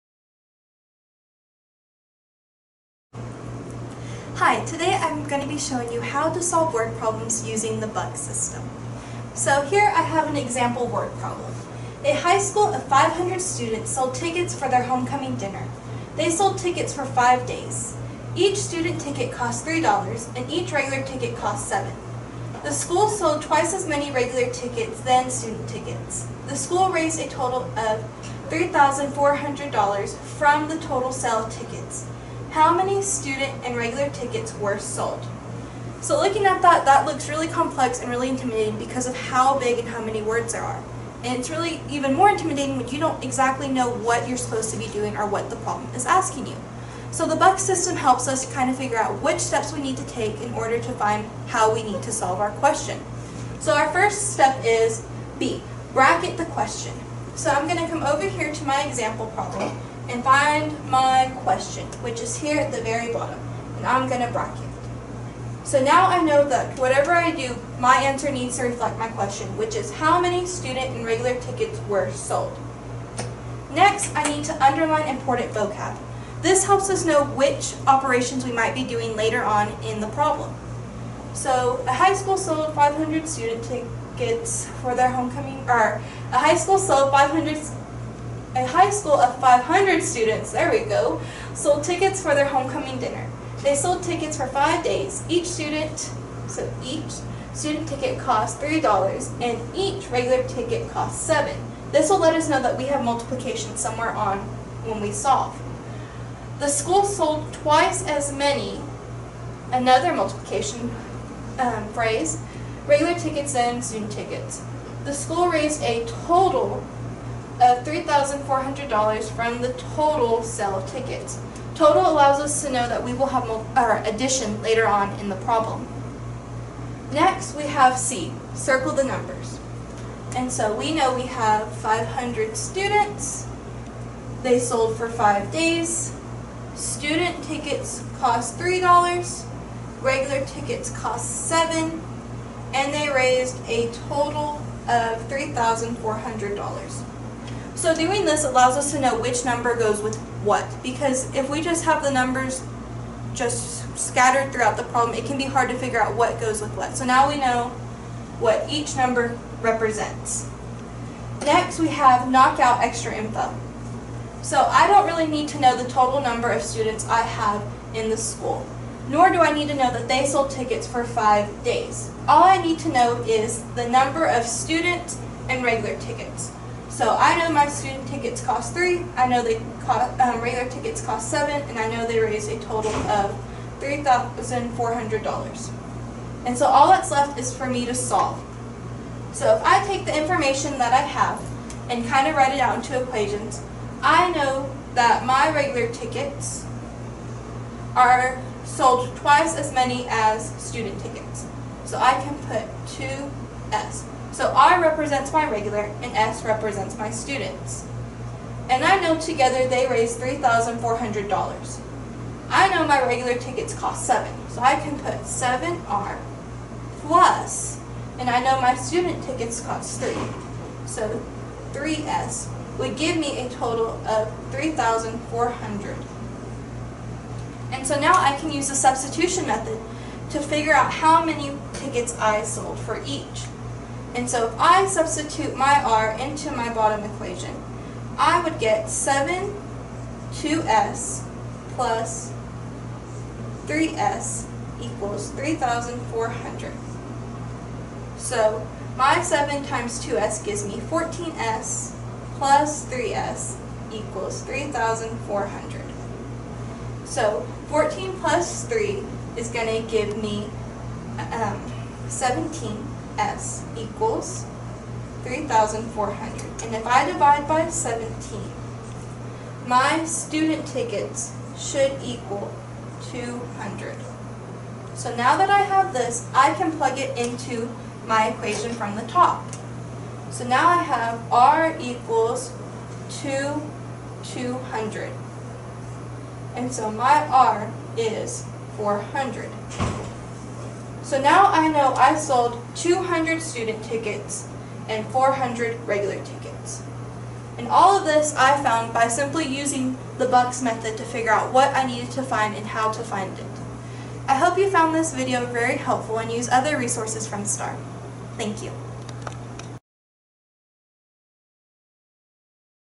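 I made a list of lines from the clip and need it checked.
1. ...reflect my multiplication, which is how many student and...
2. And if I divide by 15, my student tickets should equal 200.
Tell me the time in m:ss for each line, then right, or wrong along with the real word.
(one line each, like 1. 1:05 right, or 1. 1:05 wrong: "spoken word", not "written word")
1. 1:08 wrong: "question", not "multiplication"
2. 4:26 wrong: "17", not "15".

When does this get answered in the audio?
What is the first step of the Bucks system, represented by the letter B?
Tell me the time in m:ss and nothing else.
0:55.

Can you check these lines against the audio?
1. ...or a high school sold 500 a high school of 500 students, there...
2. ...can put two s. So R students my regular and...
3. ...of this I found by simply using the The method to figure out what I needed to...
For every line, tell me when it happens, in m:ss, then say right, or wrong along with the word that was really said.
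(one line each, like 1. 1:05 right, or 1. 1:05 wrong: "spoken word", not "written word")
1. 1:25 right
2. 3:22 wrong: "represents", not "students"
3. 4:57 wrong: "Bucks", not "The".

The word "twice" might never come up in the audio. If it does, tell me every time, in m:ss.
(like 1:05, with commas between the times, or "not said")
0:23, 1:47, 3:19.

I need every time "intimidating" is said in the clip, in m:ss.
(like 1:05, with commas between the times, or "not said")
0:38, 0:42.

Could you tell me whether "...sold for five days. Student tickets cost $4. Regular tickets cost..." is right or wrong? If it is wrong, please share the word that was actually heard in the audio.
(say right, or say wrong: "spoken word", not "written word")
wrong: "3", not "4".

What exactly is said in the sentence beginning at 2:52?
All I need to know is the number of students and regular tickets.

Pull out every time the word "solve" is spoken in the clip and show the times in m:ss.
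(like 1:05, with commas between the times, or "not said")
0:06, 0:52, 1:45, 3:07.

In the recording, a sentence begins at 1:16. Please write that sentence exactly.
This helps us know which operations we might be doing later on in the problem.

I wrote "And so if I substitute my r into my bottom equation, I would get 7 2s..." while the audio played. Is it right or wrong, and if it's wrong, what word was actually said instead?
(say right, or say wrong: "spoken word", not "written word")
right.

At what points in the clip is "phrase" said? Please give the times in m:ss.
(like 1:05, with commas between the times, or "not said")
1:51.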